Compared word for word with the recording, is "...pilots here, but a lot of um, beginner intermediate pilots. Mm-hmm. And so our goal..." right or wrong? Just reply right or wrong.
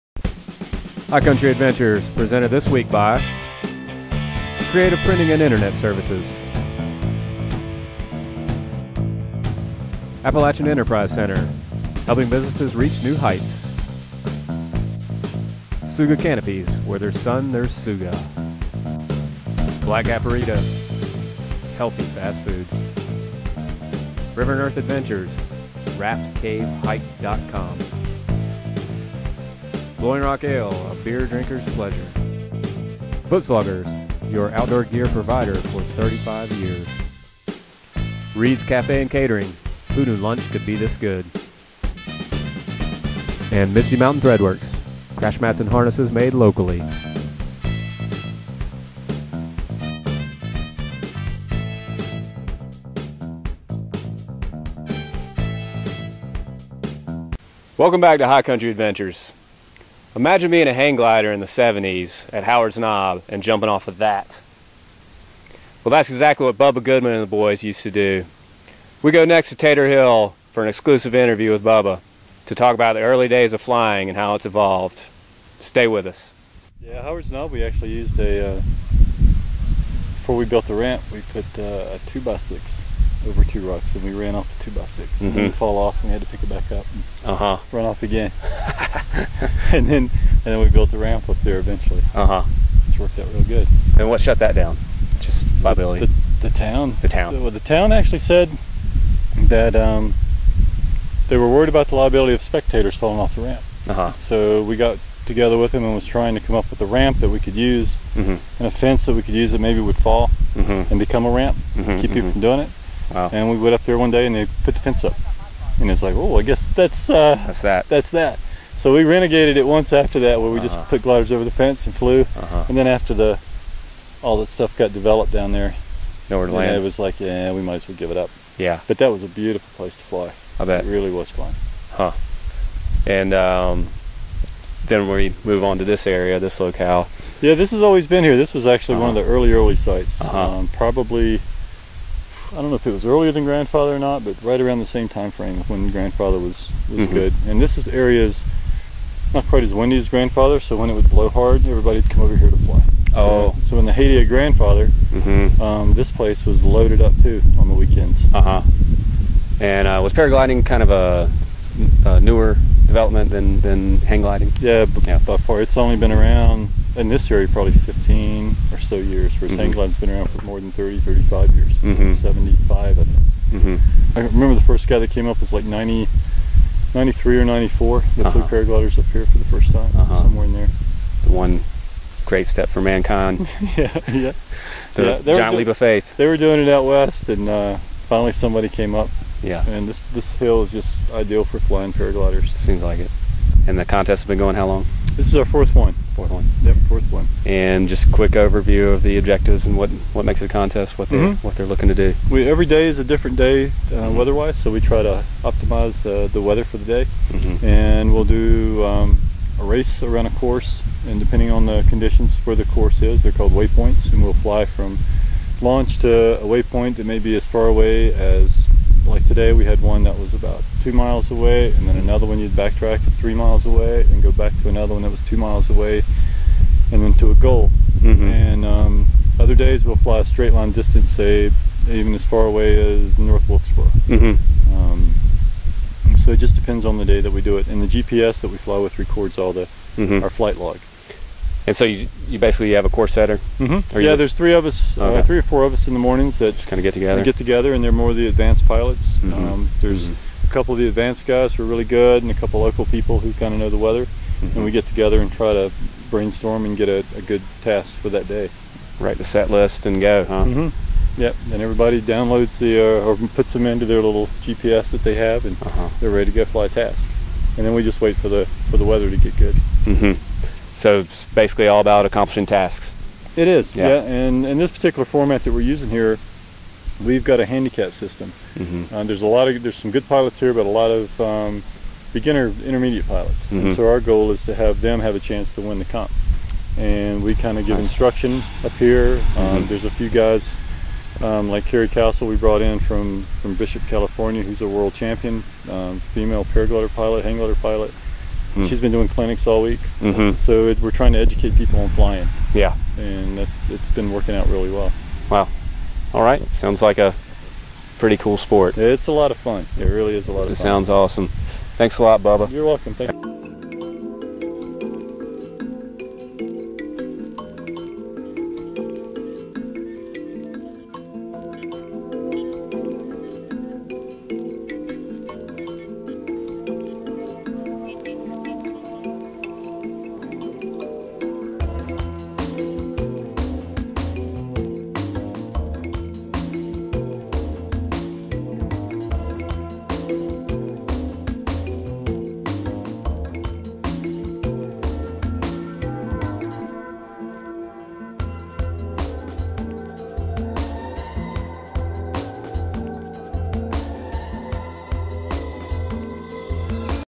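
right.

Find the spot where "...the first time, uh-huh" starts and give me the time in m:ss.
2:59.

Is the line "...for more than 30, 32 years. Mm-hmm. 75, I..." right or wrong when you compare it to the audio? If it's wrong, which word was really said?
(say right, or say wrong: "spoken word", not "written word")
wrong: "35", not "32".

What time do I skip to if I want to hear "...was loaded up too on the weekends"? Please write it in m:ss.
2:36.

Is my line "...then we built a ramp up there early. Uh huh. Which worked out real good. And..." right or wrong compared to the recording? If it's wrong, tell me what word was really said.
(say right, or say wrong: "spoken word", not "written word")
wrong: "eventually", not "early".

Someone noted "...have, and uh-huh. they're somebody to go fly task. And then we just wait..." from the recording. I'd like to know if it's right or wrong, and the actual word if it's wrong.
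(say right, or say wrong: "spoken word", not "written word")
wrong: "ready", not "somebody".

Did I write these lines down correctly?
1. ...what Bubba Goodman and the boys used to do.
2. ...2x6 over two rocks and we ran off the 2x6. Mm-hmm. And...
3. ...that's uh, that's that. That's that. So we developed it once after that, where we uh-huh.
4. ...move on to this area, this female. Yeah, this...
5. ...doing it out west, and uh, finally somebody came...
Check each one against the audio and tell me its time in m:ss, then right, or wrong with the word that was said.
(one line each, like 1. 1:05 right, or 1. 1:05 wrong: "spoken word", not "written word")
1. 1:06 right
2. 1:22 right
3. 1:56 wrong: "renegated", not "developed"
4. 2:15 wrong: "locale", not "female"
5. 3:06 right.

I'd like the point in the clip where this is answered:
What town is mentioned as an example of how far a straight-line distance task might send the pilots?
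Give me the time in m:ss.
3:53.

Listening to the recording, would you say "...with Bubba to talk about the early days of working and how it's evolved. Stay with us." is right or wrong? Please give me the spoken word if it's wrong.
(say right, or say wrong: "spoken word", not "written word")
wrong: "flying", not "working".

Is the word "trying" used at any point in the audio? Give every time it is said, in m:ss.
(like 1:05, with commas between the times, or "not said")
1:46, 5:00.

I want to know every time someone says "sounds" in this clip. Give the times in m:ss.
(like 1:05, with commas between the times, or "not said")
5:06, 5:10.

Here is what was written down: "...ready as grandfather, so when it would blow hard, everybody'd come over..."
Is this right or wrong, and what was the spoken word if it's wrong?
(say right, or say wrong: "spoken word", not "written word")
wrong: "windy", not "ready".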